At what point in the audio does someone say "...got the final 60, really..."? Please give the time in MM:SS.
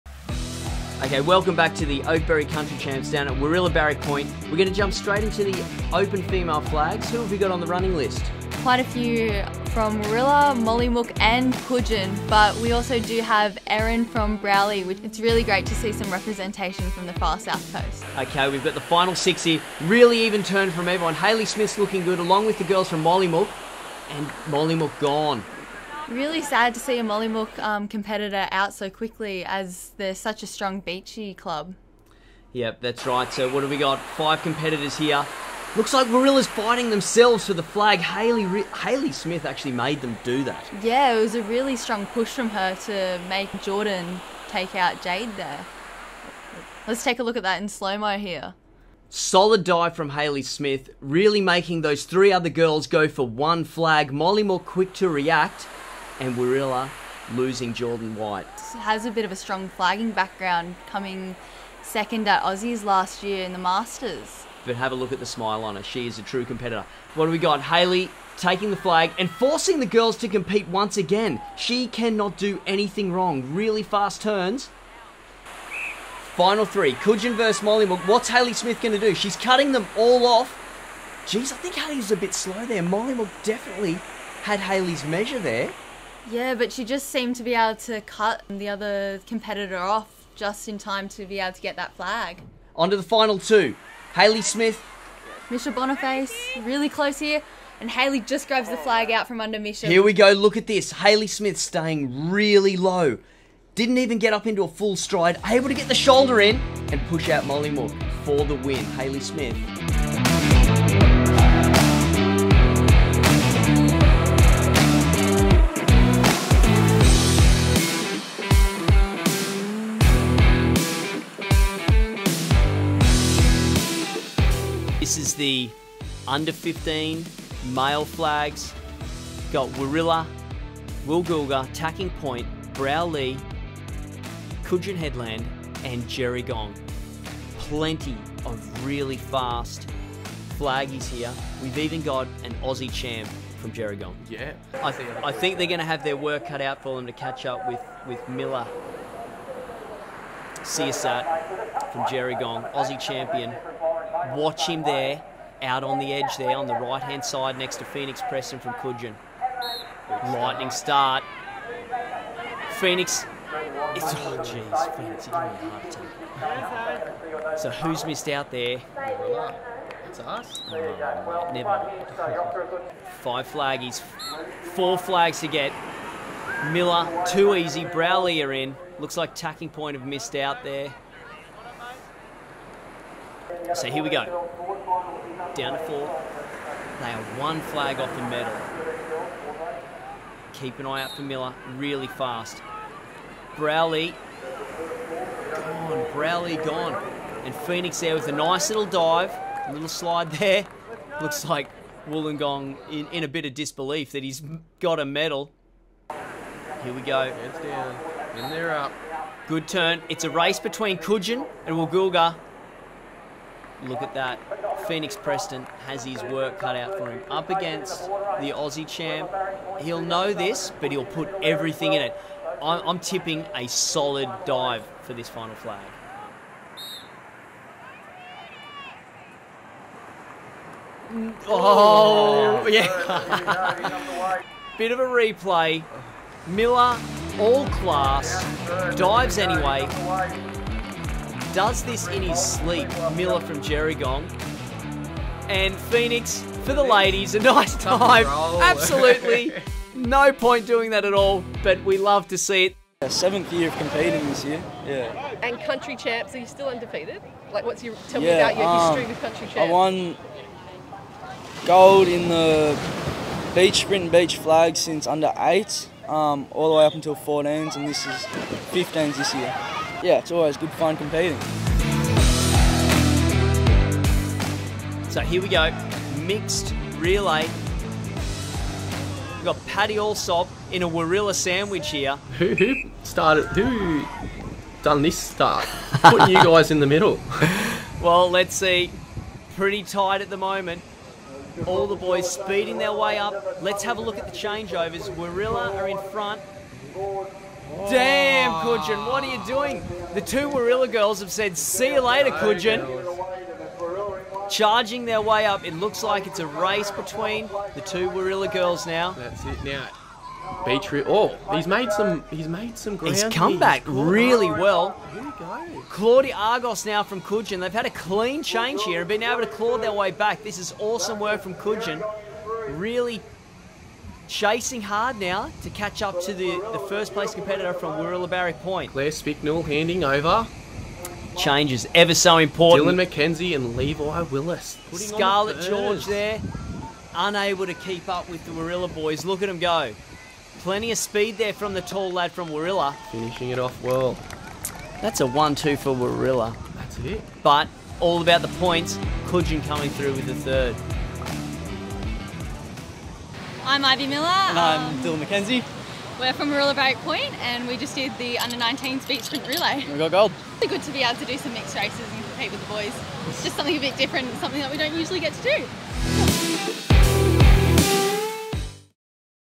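00:18.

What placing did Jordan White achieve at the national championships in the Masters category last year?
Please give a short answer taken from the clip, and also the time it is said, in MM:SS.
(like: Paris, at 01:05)
Second, at 01:01.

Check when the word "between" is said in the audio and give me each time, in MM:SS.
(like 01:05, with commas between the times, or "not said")
03:30, 05:06.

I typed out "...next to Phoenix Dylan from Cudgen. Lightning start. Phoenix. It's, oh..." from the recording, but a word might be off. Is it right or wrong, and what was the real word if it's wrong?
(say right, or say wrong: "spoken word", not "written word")
wrong: "Preston", not "Dylan".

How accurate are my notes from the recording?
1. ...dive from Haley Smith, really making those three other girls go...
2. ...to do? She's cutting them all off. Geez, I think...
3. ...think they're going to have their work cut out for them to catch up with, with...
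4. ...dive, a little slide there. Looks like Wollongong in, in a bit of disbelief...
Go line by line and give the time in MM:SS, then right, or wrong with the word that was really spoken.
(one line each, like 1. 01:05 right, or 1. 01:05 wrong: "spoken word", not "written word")
1. 00:49 right
2. 01:18 right
3. 02:25 right
4. 03:18 right.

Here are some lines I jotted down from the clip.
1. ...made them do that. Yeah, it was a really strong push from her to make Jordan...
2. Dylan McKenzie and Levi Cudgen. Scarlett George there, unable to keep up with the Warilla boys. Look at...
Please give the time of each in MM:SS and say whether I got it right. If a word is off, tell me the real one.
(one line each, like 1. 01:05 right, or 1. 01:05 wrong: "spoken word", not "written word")
1. 00:39 right
2. 05:32 wrong: "Willis", not "Cudgen".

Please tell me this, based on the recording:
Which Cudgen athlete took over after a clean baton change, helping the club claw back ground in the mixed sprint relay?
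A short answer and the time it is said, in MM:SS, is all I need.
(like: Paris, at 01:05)
Claudia Argos, at 05:15.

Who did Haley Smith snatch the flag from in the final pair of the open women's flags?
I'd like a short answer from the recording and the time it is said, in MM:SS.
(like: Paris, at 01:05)
Misha Boniface, at 01:35.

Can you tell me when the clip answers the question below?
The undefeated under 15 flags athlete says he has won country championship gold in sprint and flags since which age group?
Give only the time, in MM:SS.
04:24.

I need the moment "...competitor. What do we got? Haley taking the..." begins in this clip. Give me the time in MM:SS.
01:06.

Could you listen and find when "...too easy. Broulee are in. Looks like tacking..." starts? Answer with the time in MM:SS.
02:57.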